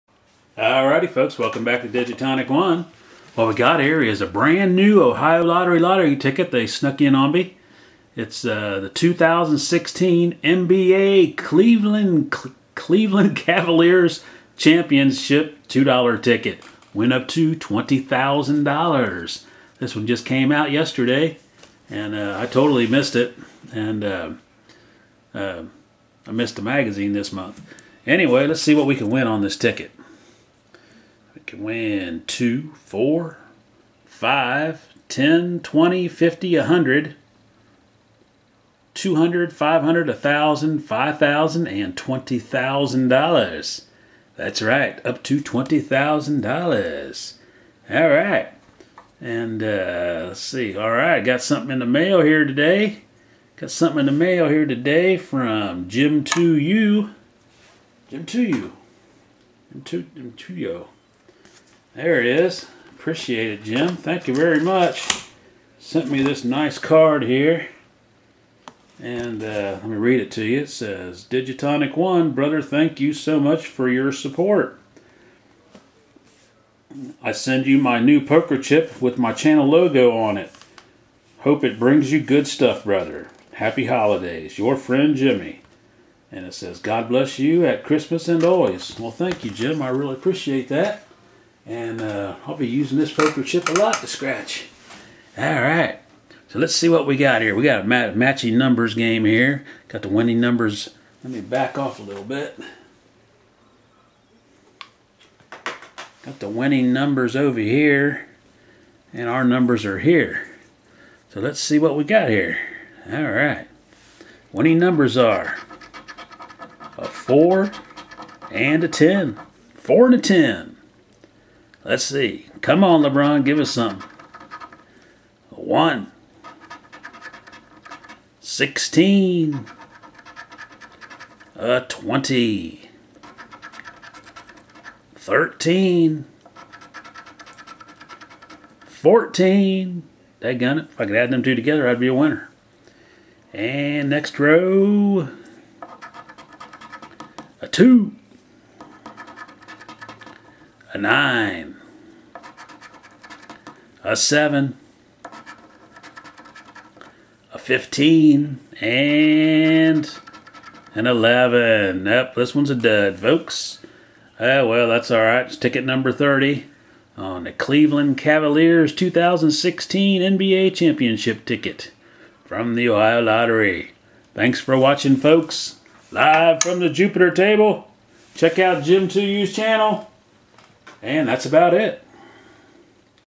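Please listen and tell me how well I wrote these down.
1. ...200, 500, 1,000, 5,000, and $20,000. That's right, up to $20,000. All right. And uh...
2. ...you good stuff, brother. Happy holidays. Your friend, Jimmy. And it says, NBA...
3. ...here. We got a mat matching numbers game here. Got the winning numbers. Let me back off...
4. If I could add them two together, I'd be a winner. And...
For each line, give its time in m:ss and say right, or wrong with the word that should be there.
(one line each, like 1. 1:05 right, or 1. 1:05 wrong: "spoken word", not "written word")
1. 0:38 right
2. 1:22 wrong: "God", not "NBA"
3. 1:37 right
4. 2:20 right.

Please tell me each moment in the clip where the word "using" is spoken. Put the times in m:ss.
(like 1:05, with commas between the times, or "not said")
1:32.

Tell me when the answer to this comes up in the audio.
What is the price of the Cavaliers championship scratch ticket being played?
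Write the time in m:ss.
0:15.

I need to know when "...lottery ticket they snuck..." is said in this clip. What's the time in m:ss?
0:05.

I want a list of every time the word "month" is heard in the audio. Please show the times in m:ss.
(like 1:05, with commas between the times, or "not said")
0:27.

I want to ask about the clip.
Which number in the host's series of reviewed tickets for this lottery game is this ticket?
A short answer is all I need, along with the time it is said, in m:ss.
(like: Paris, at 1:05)
30, at 2:45.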